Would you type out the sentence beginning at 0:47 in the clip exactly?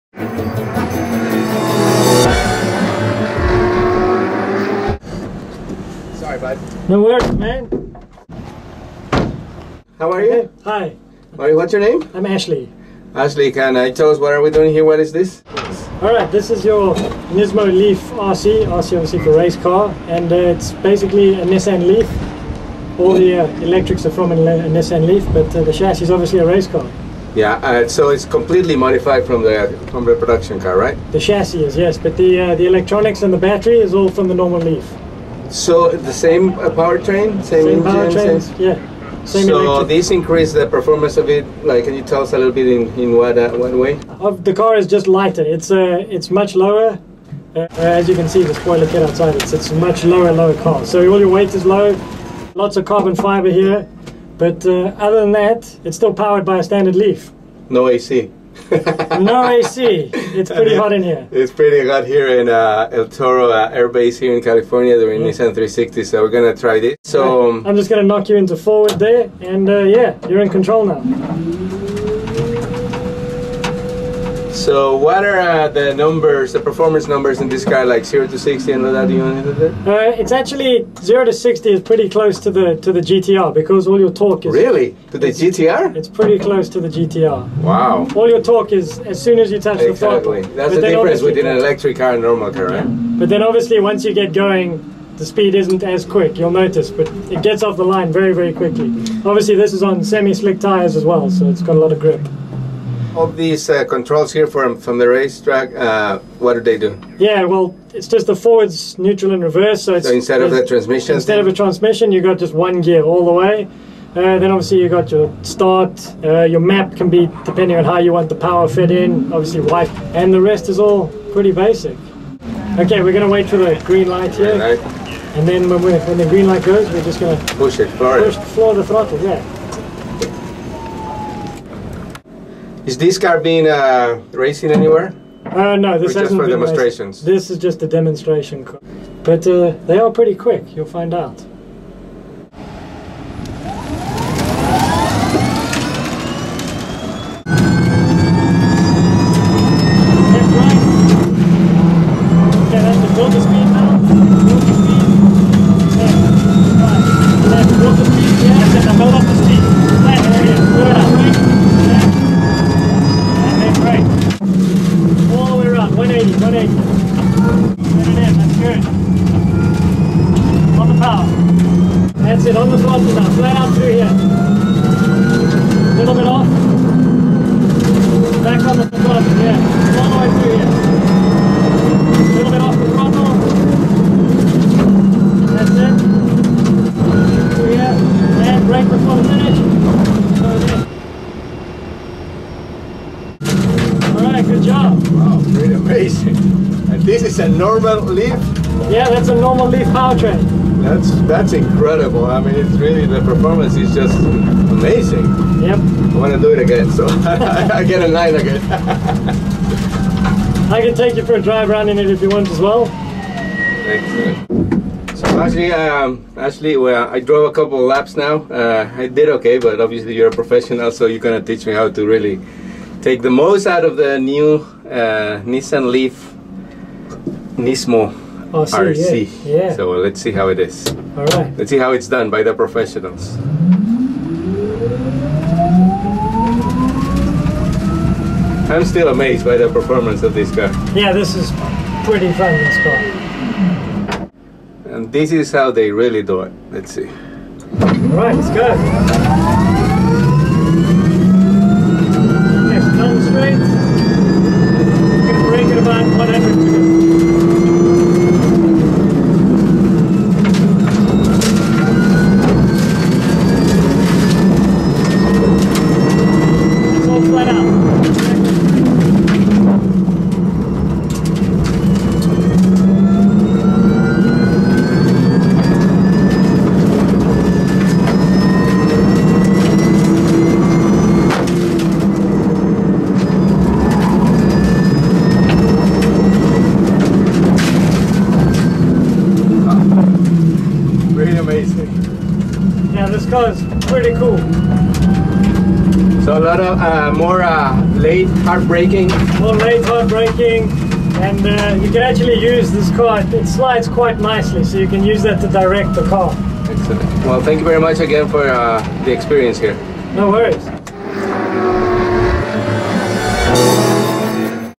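Uh, as you can see, the spoiler kit outside.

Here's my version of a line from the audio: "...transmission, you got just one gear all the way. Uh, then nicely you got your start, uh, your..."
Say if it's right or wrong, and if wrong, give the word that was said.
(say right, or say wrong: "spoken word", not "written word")
wrong: "obviously", not "nicely".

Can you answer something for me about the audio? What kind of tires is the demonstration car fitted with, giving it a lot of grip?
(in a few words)
Semi-slick tires.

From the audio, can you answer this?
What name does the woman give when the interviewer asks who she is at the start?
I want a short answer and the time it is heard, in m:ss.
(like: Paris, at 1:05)
Ashley, at 0:12.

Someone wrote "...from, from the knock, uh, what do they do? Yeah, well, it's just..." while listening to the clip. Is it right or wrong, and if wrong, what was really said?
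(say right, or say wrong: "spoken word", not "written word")
wrong: "racetrack", not "knock".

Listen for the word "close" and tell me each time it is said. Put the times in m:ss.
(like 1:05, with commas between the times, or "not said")
1:22, 1:26.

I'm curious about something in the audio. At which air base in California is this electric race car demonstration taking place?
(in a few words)
El Toro.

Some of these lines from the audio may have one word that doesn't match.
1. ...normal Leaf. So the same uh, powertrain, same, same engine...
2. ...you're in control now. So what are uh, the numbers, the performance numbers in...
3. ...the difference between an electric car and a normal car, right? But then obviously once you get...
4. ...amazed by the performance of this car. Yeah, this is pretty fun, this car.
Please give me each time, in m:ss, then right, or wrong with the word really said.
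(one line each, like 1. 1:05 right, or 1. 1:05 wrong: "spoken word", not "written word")
1. 0:34 right
2. 1:10 right
3. 1:30 right
4. 3:59 right.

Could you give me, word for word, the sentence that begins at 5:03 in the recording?
It slides quite nicely, so you can use that to direct the car.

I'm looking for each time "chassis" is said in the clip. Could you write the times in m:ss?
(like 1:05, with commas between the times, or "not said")
0:25, 0:31.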